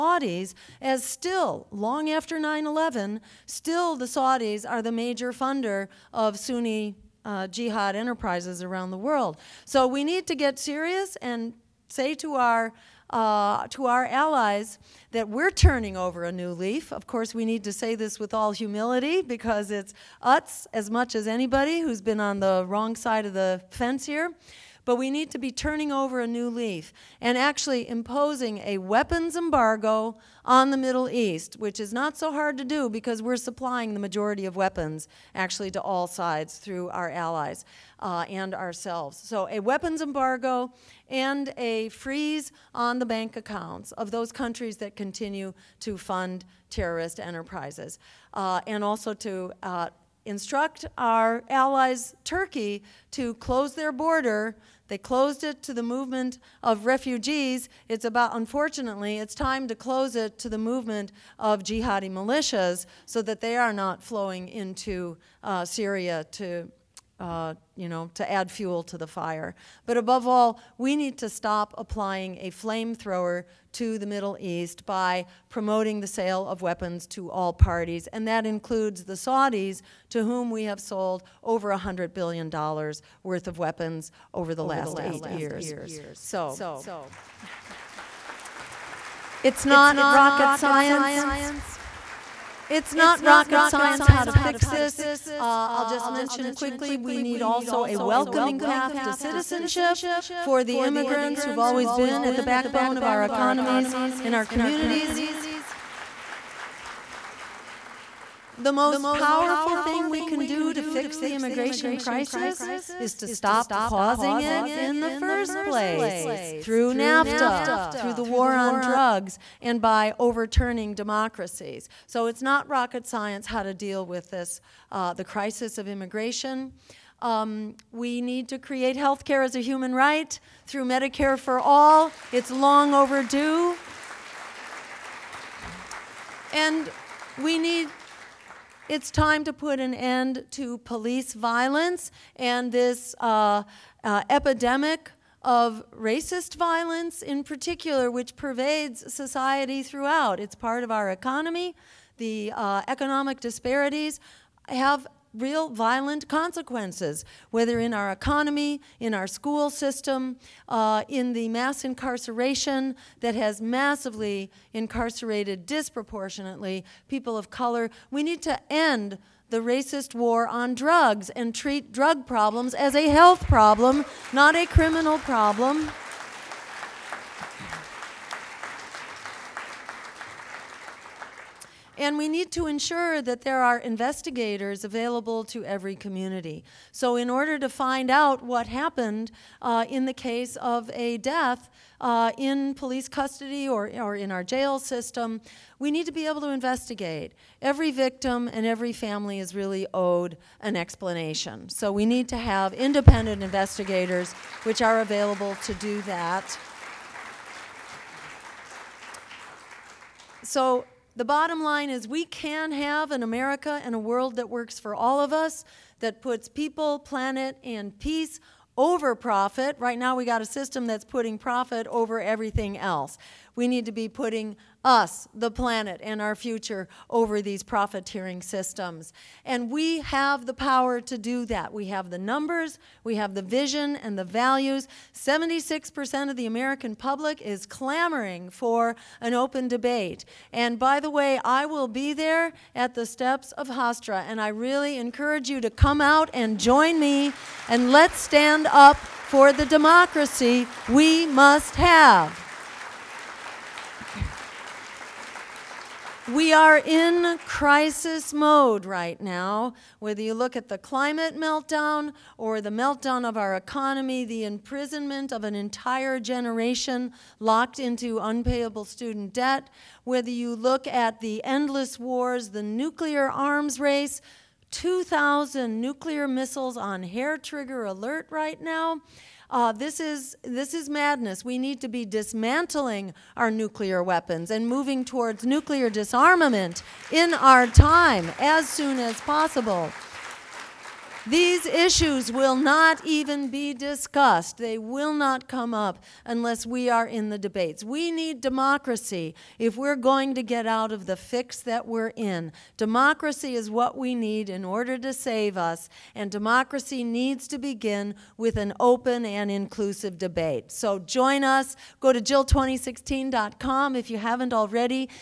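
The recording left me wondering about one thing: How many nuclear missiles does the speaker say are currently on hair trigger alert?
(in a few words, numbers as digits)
2,000.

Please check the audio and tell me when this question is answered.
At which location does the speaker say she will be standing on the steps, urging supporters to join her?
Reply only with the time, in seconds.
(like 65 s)
243 s.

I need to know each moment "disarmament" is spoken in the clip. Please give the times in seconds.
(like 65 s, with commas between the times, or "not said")
285 s.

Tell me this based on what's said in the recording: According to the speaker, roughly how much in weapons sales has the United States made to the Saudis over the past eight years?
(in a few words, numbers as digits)
Over $100 billion.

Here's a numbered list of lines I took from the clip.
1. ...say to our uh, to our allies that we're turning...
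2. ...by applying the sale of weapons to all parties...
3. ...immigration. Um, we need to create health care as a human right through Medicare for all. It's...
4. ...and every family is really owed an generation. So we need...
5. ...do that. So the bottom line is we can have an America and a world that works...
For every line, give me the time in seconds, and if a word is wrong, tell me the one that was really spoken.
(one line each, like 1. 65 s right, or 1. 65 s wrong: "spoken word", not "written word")
1. 11 s right
2. 74 s wrong: "promoting", not "applying"
3. 125 s right
4. 198 s wrong: "explanation", not "generation"
5. 205 s right.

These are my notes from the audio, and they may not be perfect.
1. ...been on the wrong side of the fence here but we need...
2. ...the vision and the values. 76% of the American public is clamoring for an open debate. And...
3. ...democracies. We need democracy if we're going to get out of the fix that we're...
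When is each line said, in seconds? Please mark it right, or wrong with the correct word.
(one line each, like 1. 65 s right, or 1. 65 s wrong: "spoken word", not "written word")
1. 22 s right
2. 233 s right
3. 297 s wrong: "debates", not "democracies".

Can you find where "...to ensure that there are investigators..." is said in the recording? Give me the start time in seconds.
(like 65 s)
182 s.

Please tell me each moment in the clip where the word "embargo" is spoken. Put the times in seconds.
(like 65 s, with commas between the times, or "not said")
29 s, 40 s.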